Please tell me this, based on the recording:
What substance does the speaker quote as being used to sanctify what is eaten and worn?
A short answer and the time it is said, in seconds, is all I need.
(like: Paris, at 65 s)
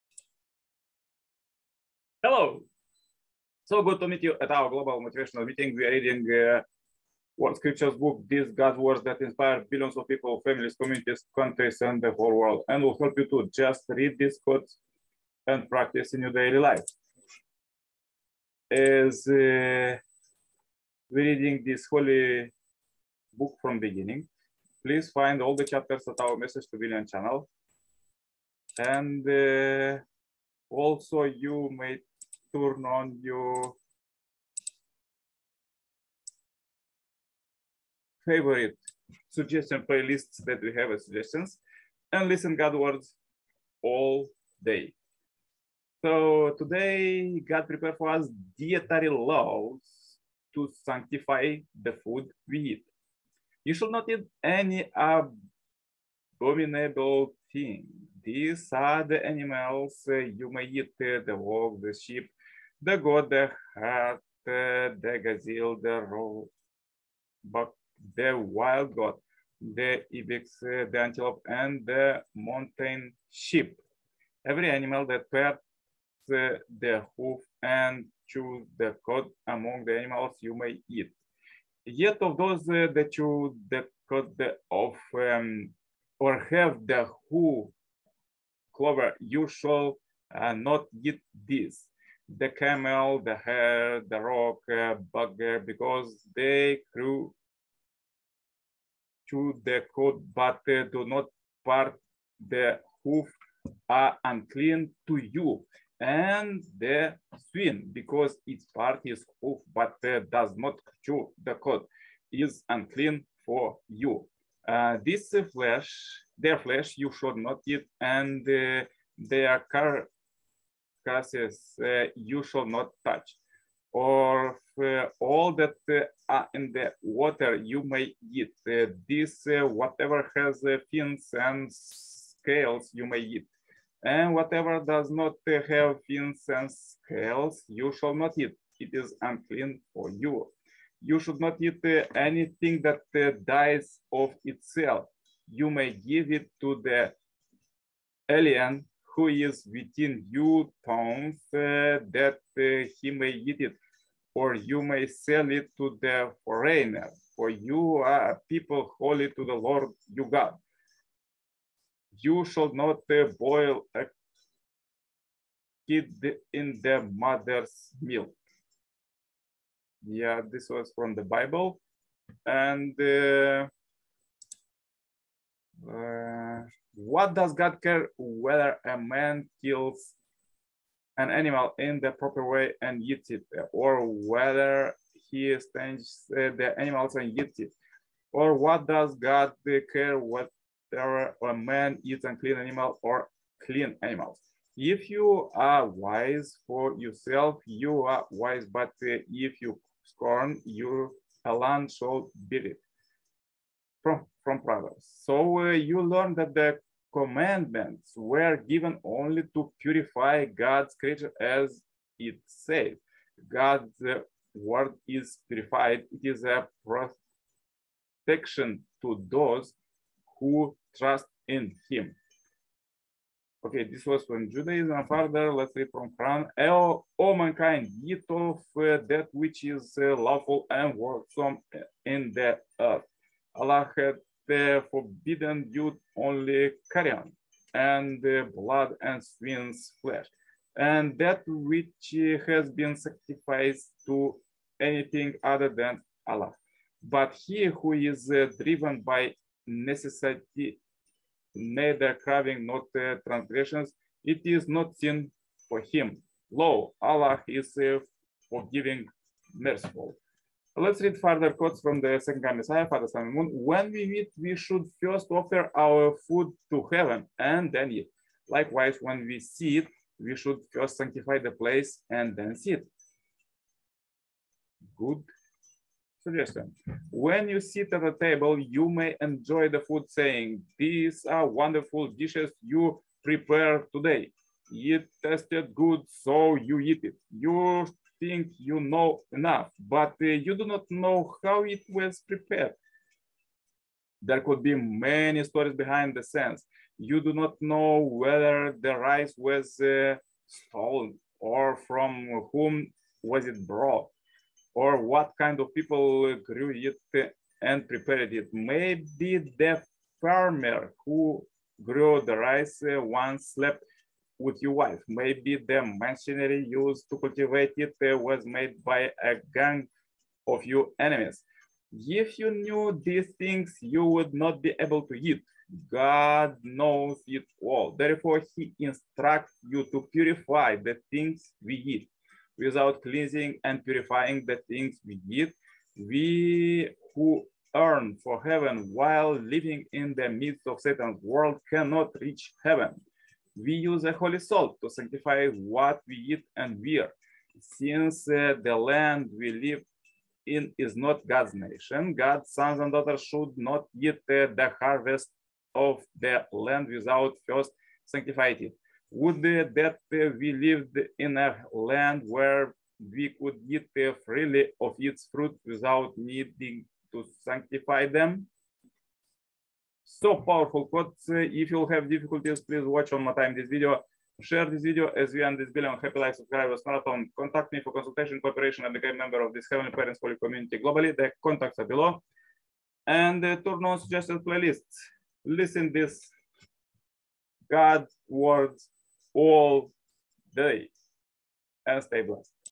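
holy salt, at 344 s.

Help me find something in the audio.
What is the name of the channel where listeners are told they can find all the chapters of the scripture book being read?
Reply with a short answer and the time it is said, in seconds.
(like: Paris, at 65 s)
Message to Billion, at 26 s.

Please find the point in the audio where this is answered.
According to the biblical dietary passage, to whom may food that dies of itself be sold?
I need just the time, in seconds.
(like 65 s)
156 s.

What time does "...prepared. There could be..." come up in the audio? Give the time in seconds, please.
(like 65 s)
292 s.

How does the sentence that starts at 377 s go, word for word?
Contact me for consultation, cooperation, and become a member of this Heavenly Parents Holy Community globally.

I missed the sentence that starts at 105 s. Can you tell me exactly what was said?
And the swine, because its part is hoof, but uh, does not chew the coat, is unclean for you.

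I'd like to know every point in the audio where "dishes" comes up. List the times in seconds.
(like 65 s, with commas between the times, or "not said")
282 s.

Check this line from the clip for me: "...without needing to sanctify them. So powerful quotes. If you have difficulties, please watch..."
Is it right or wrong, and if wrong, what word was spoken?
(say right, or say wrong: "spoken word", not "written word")
right.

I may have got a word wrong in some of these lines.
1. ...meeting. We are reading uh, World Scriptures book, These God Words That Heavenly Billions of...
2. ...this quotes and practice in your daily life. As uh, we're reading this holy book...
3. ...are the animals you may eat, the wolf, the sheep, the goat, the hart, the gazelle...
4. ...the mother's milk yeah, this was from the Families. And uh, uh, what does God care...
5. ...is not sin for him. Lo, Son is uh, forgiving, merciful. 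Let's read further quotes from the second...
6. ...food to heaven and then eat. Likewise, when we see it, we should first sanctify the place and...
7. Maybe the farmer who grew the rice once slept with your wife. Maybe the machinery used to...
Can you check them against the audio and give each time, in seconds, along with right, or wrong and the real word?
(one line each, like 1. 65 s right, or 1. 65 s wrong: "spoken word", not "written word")
1. 5 s wrong: "Inspire", not "Heavenly"
2. 14 s right
3. 58 s right
4. 166 s wrong: "Bible", not "Families"
5. 254 s wrong: "Allah", not "Son"
6. 266 s right
7. 308 s right.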